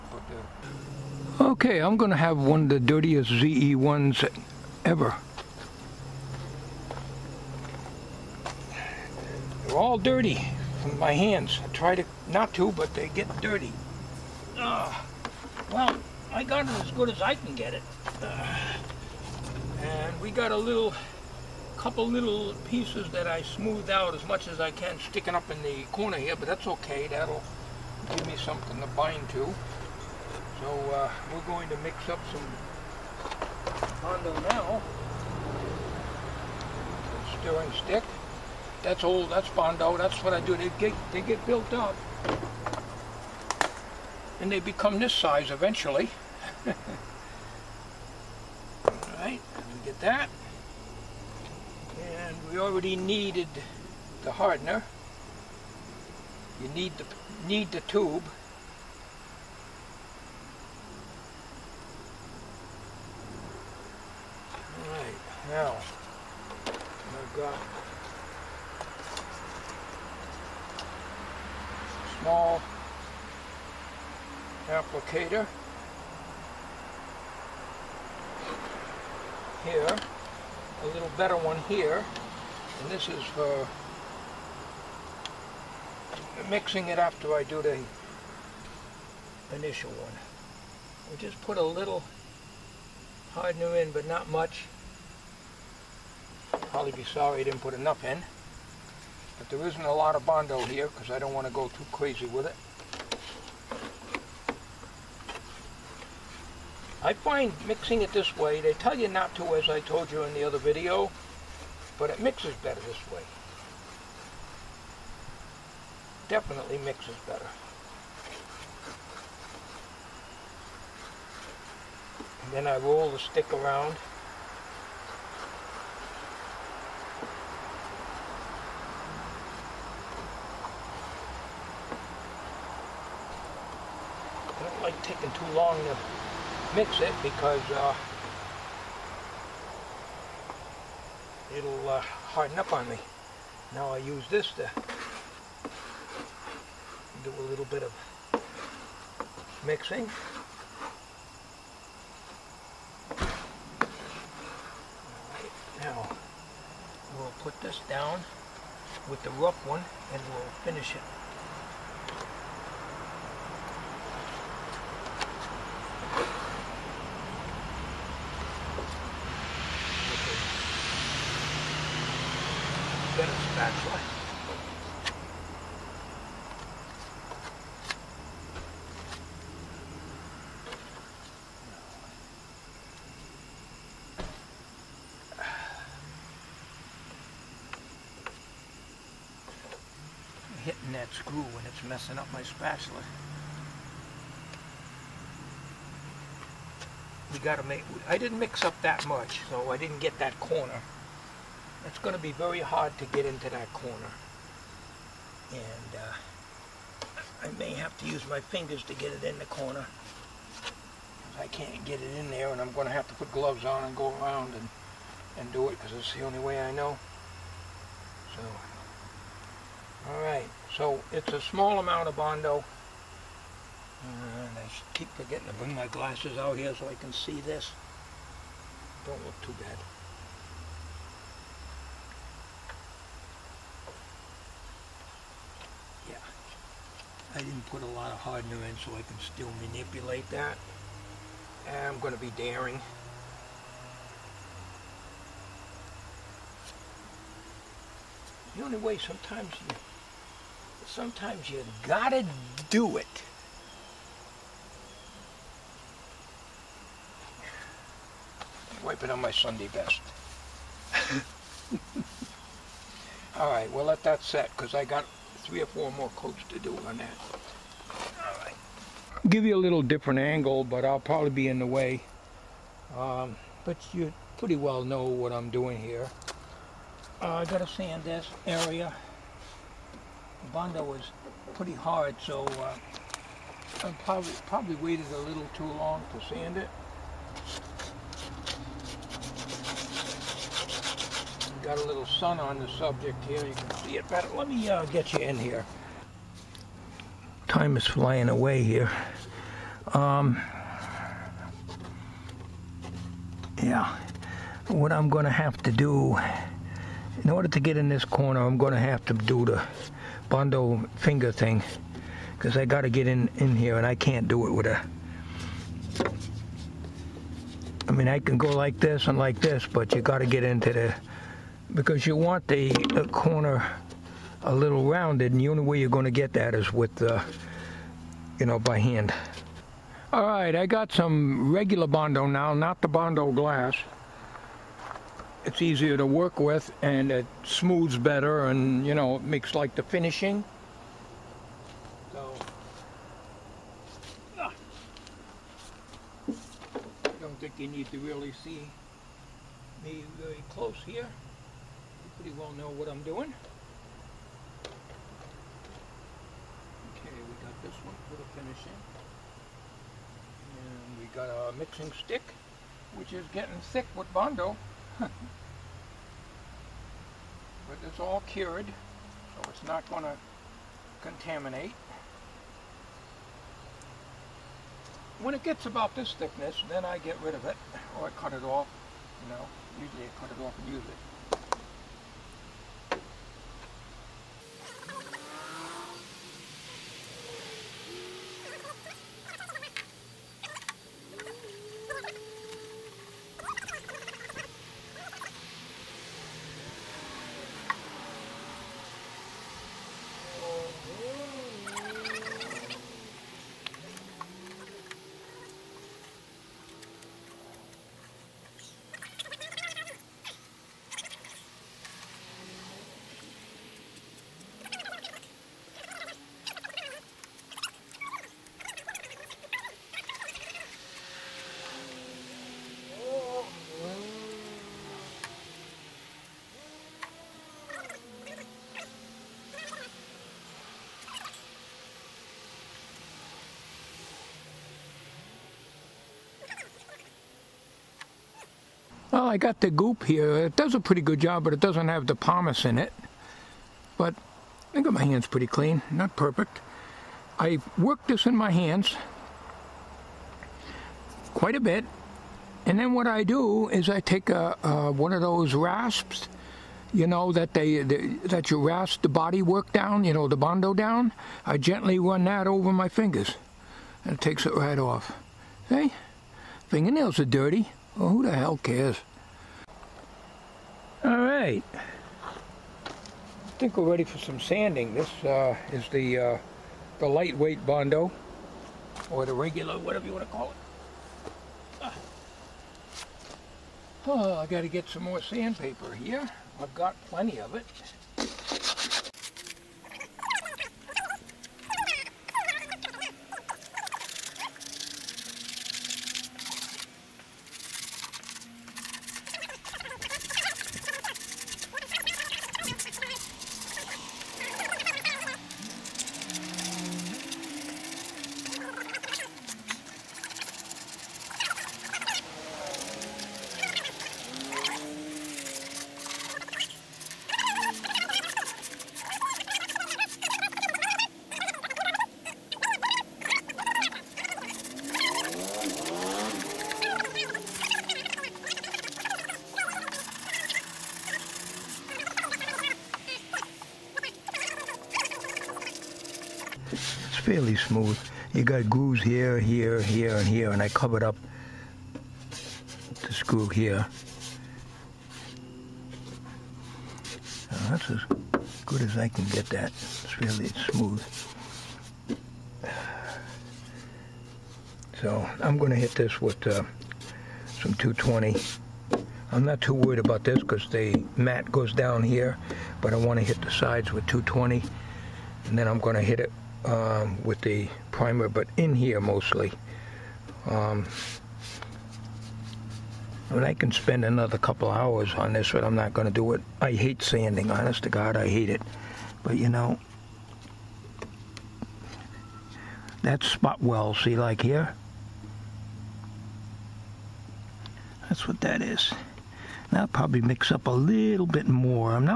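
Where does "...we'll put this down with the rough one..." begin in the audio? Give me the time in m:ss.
2:37.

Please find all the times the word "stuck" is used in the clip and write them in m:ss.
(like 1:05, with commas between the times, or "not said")
not said.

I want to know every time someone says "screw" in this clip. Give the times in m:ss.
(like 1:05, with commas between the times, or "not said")
3:11, 9:03.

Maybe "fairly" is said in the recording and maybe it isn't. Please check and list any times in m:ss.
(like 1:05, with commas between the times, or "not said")
8:57, 9:10.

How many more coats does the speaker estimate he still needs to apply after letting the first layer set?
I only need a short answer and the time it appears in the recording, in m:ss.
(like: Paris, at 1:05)
3 or 4, at 4:25.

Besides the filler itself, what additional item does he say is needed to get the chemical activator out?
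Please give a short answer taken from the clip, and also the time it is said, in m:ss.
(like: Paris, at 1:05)
The tube, at 0:57.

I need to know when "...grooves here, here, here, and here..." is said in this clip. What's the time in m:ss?
8:58.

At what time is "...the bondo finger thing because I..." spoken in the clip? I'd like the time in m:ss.
5:09.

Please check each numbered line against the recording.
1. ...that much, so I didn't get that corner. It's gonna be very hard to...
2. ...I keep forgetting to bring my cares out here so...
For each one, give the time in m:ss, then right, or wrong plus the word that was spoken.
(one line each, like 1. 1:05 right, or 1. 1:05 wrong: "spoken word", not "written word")
1. 3:18 right
2. 3:44 wrong: "glasses", not "cares".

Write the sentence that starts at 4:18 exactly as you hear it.
Wipe it on my Sunday best.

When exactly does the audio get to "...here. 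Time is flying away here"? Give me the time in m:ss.
4:55.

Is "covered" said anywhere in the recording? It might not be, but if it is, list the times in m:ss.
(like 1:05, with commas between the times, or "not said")
9:00.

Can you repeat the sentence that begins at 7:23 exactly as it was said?
But I got my hands pretty clean, not perfect.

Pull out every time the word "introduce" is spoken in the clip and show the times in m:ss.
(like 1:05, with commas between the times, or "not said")
not said.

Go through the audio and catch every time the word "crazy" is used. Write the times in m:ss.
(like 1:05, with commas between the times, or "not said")
1:41.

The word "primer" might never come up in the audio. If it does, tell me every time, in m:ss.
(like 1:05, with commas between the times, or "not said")
9:27.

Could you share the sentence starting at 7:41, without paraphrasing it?
I gently run that over my fingers, and it takes it right off.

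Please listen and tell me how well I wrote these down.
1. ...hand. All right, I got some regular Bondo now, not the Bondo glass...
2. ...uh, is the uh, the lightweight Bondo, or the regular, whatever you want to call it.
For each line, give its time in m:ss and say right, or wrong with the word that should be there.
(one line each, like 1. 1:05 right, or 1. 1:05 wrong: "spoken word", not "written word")
1. 5:28 right
2. 7:55 right.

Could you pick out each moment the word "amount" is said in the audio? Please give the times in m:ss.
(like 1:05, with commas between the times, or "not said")
3:41.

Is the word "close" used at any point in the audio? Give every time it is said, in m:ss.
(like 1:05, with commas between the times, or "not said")
5:50.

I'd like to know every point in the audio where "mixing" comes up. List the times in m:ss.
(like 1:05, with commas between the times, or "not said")
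1:26, 1:47, 2:29, 6:01.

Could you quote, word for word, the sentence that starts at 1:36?
Probably be sorry I didn't put enough in.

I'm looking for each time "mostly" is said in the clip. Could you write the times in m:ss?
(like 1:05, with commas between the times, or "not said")
9:28.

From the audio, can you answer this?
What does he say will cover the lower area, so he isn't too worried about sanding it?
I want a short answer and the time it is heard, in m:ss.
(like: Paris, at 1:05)
The mat, at 9:20.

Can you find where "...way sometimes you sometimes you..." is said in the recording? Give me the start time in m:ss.
4:08.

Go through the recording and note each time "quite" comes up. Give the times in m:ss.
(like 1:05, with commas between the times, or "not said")
7:31.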